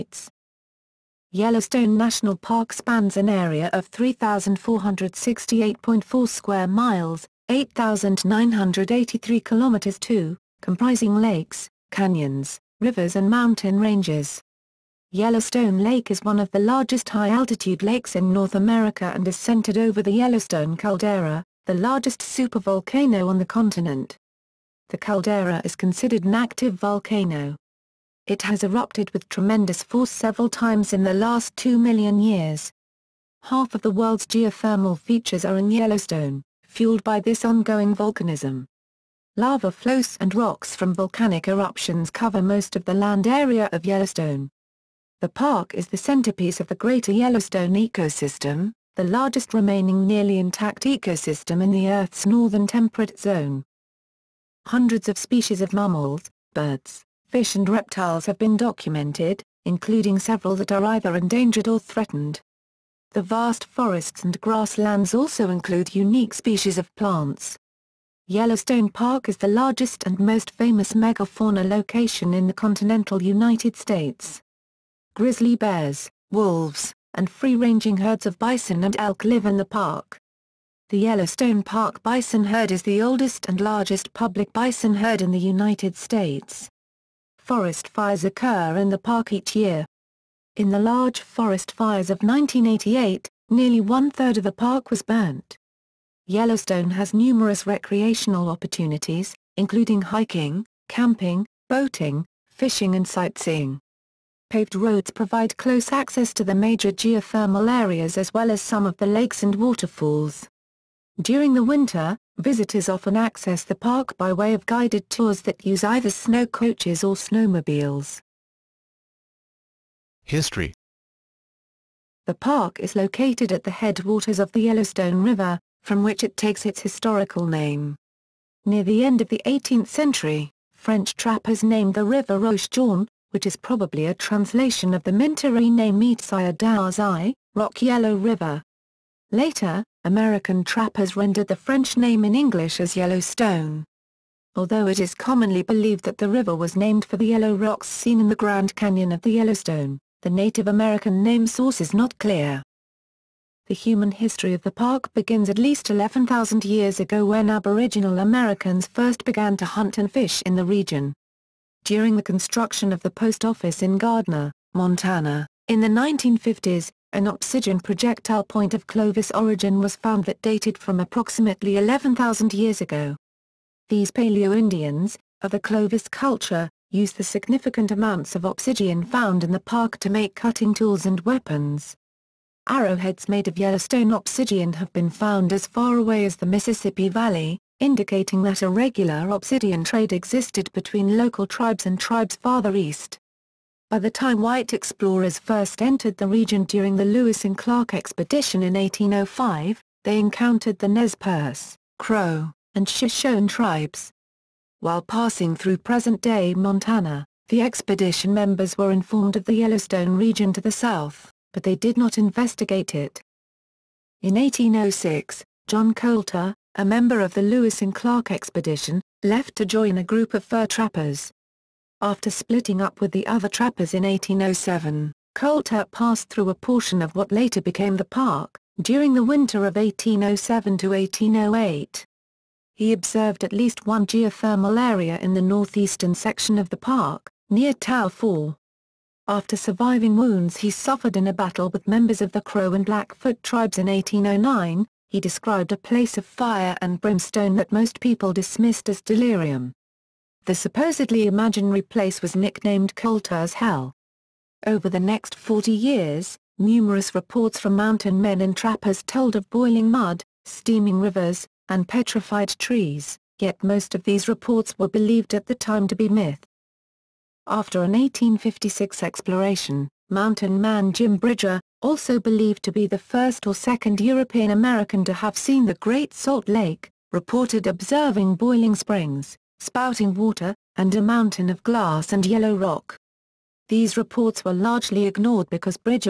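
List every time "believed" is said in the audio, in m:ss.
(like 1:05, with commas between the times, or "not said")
2:25, 4:24, 4:32.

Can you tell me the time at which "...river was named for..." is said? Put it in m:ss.
2:26.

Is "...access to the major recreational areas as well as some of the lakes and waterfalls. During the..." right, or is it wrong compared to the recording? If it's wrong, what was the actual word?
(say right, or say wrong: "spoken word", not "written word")
wrong: "geothermal", not "recreational".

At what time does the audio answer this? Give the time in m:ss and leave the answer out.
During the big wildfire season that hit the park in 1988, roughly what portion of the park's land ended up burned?
1:33.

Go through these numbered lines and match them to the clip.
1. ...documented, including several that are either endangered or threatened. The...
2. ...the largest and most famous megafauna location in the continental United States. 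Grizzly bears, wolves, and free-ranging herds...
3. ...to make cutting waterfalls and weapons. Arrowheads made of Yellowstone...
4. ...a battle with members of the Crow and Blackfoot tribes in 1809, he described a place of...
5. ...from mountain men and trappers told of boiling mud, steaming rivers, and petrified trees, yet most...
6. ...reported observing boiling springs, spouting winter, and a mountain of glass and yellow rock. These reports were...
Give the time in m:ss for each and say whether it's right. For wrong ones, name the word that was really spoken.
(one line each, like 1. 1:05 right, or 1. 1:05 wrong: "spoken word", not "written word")
1. 0:58 right
2. 1:09 right
3. 2:59 wrong: "tools", not "waterfalls"
4. 4:01 right
5. 4:17 right
6. 4:37 wrong: "water", not "winter".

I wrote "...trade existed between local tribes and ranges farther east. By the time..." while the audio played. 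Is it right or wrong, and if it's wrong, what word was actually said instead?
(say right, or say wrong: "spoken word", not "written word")
wrong: "tribes", not "ranges".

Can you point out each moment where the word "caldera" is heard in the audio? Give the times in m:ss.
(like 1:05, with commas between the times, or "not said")
0:20, 0:24.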